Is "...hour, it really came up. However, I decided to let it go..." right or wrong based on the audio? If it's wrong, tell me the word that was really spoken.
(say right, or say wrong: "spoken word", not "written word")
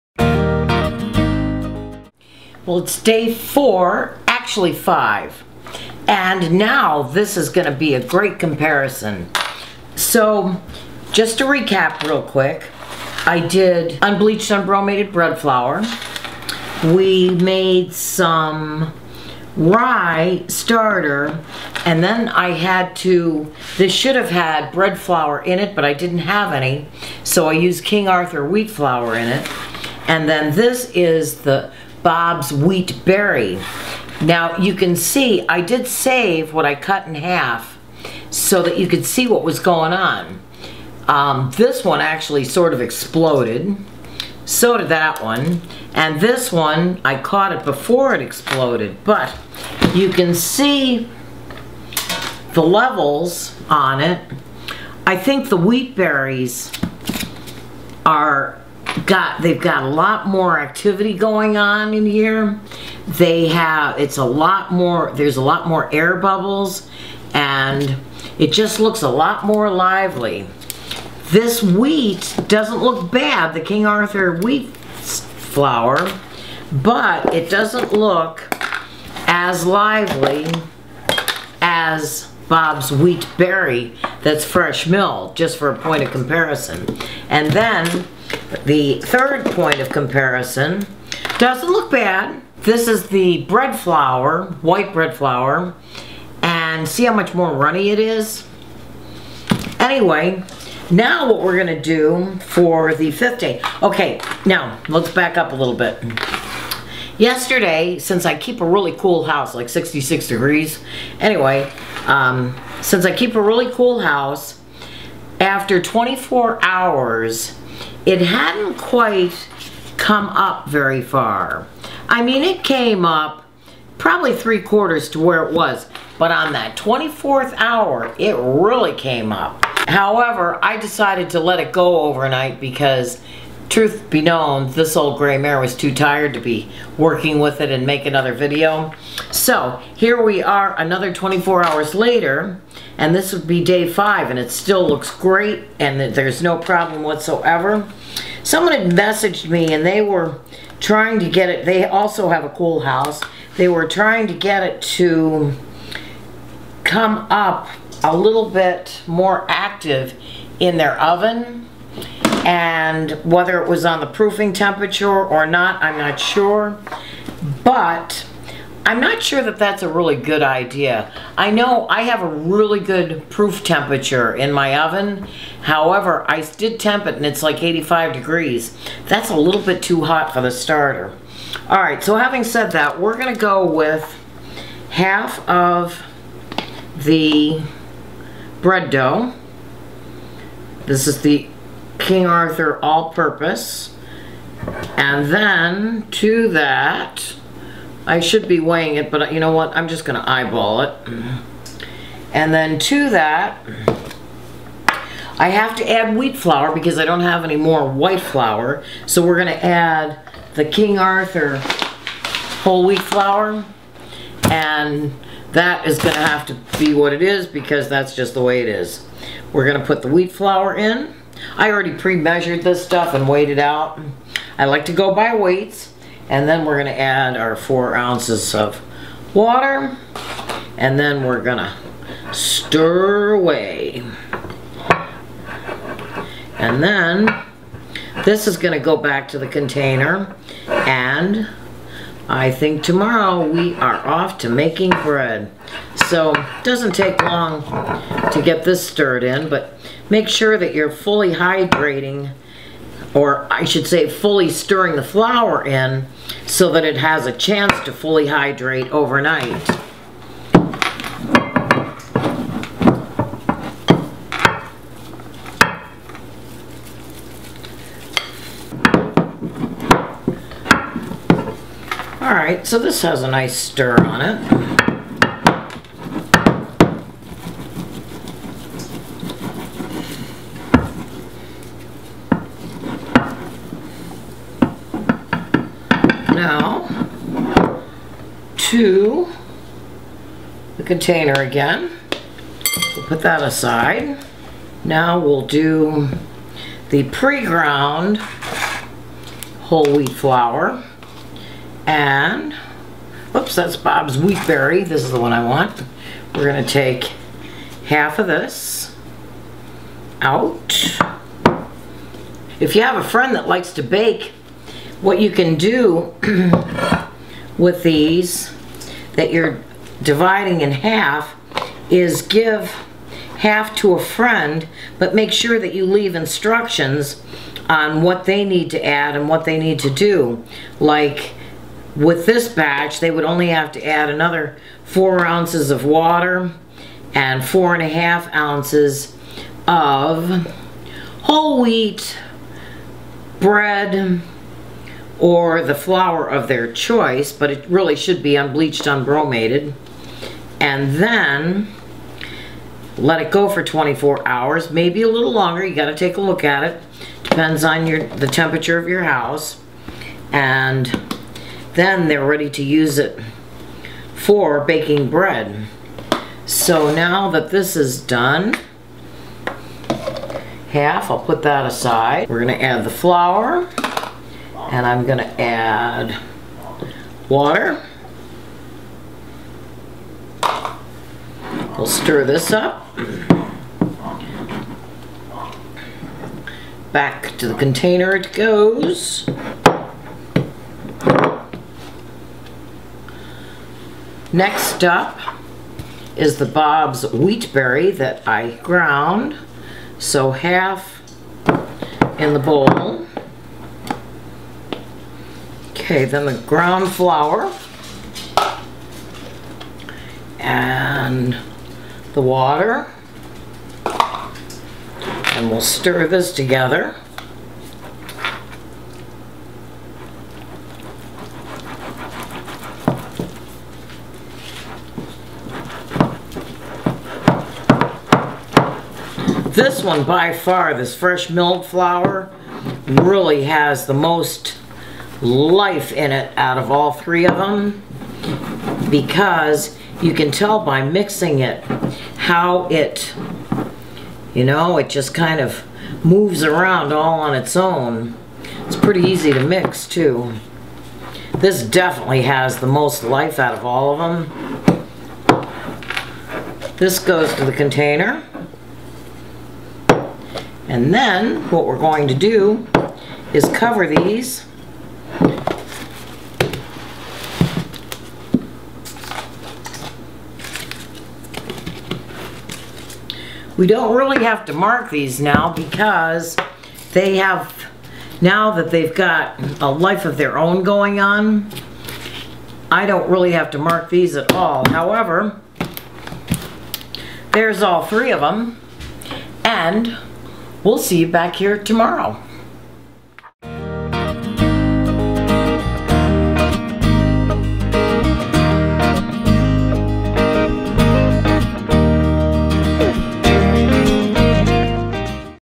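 right.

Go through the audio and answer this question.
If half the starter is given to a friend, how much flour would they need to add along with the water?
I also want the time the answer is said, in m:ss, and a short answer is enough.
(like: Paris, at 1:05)
4.5 ounces, at 5:37.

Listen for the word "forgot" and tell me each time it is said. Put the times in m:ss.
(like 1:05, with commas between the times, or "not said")
not said.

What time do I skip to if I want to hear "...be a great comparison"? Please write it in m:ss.
0:07.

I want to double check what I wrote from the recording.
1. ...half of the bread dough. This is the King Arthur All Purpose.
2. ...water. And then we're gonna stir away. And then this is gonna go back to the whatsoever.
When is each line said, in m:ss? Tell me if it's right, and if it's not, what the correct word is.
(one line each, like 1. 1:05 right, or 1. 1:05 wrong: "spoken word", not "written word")
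1. 3:04 right
2. 3:49 wrong: "container", not "whatsoever".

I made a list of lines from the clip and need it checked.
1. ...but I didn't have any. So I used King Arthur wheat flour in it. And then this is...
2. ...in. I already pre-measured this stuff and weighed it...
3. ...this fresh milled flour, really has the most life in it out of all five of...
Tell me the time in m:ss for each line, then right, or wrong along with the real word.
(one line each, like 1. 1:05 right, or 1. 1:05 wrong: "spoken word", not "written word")
1. 0:25 right
2. 3:40 right
3. 7:10 wrong: "three", not "five".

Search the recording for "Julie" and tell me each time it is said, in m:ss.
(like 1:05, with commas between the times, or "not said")
not said.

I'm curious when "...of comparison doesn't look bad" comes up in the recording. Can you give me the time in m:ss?
1:29.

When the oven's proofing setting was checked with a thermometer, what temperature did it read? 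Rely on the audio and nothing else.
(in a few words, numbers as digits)
85 degrees.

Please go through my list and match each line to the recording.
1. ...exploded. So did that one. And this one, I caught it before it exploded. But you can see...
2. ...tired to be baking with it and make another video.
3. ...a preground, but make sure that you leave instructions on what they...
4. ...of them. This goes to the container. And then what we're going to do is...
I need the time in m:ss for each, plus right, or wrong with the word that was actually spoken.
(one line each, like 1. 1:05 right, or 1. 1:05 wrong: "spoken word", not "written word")
1. 0:42 right
2. 2:15 wrong: "working", not "baking"
3. 5:23 wrong: "friend", not "preground"
4. 7:34 right.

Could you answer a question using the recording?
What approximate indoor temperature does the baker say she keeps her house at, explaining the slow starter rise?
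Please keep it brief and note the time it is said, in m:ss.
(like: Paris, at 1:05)
66 degrees, at 1:49.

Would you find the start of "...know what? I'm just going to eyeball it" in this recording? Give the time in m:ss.
3:19.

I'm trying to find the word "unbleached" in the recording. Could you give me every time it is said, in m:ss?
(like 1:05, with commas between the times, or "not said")
0:14, 5:48.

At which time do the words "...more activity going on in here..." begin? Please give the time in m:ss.
1:00.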